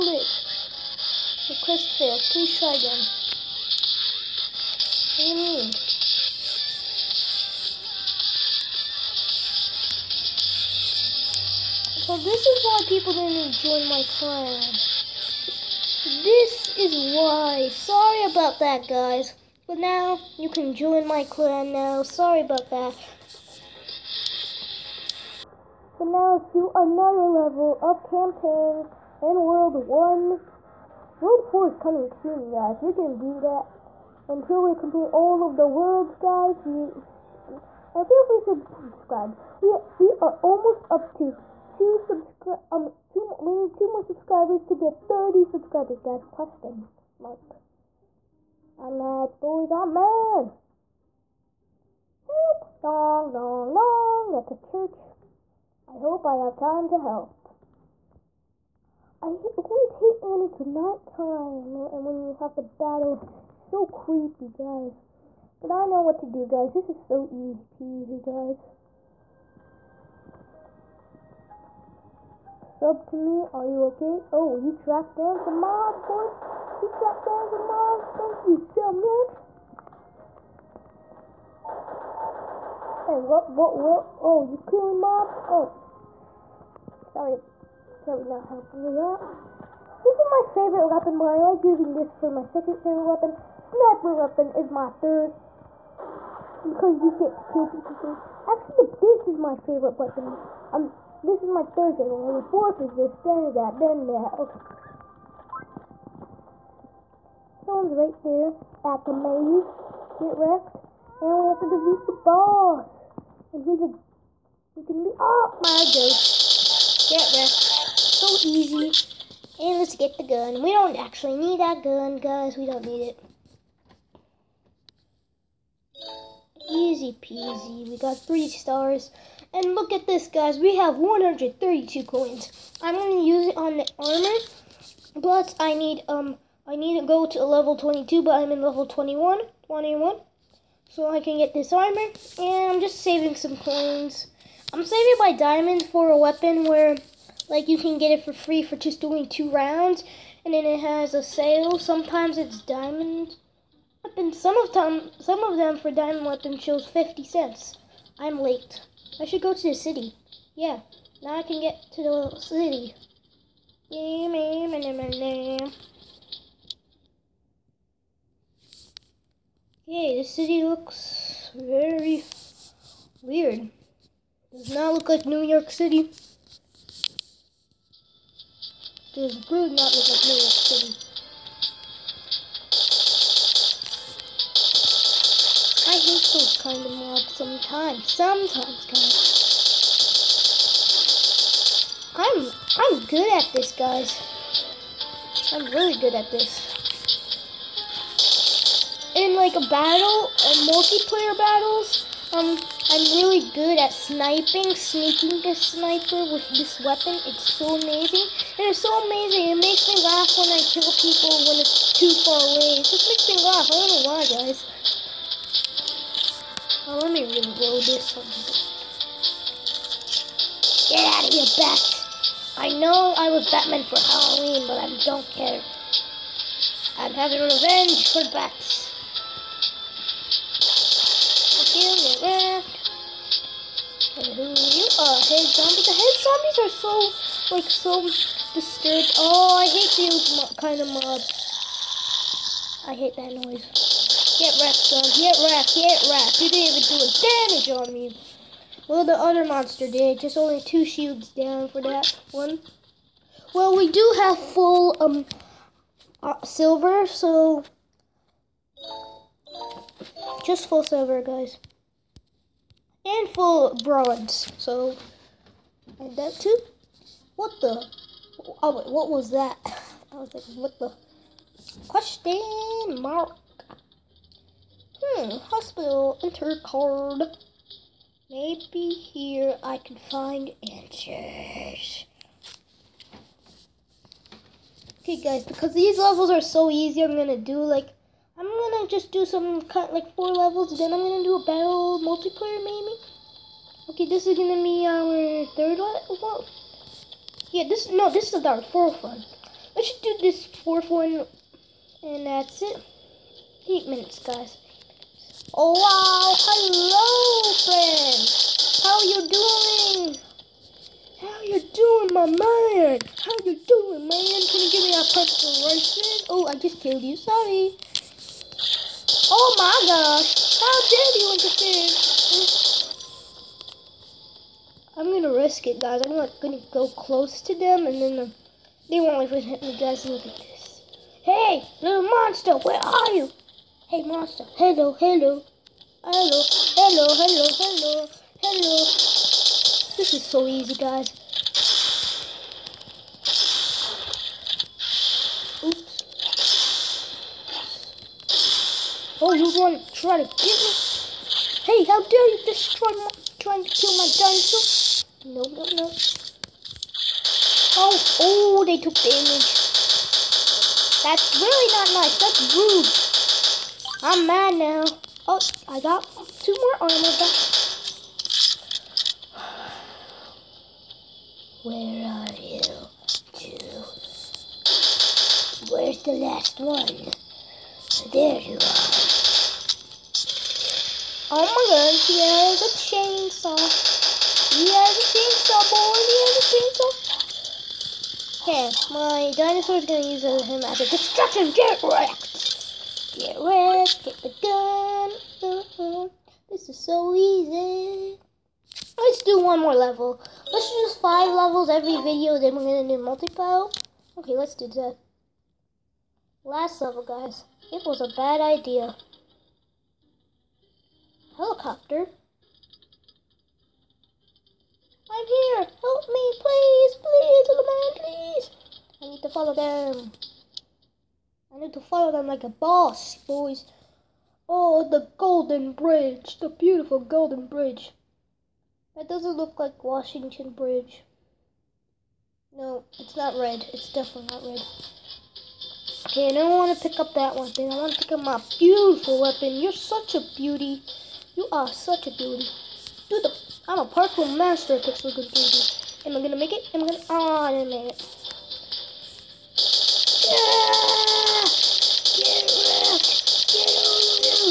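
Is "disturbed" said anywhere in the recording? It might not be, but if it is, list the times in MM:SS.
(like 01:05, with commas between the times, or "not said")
03:58.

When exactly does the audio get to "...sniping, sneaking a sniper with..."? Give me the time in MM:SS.
03:23.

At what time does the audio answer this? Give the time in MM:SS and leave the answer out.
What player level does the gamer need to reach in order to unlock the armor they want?
02:17.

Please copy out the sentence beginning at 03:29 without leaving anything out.
It makes me laugh when I kill people when it's too far away.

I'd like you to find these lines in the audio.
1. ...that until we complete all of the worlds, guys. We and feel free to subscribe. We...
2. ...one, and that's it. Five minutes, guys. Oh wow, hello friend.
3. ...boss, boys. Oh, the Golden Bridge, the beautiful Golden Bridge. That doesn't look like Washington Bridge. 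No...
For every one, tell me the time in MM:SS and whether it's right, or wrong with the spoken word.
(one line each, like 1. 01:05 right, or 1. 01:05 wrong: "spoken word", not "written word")
1. 00:33 right
2. 05:00 wrong: "Eight", not "Five"
3. 07:02 right.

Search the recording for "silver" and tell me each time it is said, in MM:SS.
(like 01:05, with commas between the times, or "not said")
04:16, 04:20.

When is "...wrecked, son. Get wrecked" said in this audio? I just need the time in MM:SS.
04:04.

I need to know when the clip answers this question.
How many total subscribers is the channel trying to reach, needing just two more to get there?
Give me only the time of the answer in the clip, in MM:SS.
00:45.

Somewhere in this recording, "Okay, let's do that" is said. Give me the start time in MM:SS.
06:44.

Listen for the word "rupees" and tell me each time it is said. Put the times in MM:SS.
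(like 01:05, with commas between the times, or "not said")
not said.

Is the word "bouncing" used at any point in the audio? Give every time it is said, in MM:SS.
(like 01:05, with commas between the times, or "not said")
not said.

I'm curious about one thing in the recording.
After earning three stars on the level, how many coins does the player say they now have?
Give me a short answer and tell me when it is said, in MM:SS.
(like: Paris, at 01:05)
132, at 02:10.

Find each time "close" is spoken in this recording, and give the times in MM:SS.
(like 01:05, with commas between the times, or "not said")
05:26.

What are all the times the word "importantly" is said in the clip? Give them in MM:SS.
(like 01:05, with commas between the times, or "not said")
not said.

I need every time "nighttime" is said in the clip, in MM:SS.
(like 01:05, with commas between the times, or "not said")
01:00.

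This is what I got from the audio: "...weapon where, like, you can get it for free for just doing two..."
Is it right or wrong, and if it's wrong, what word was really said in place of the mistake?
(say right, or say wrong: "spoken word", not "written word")
right.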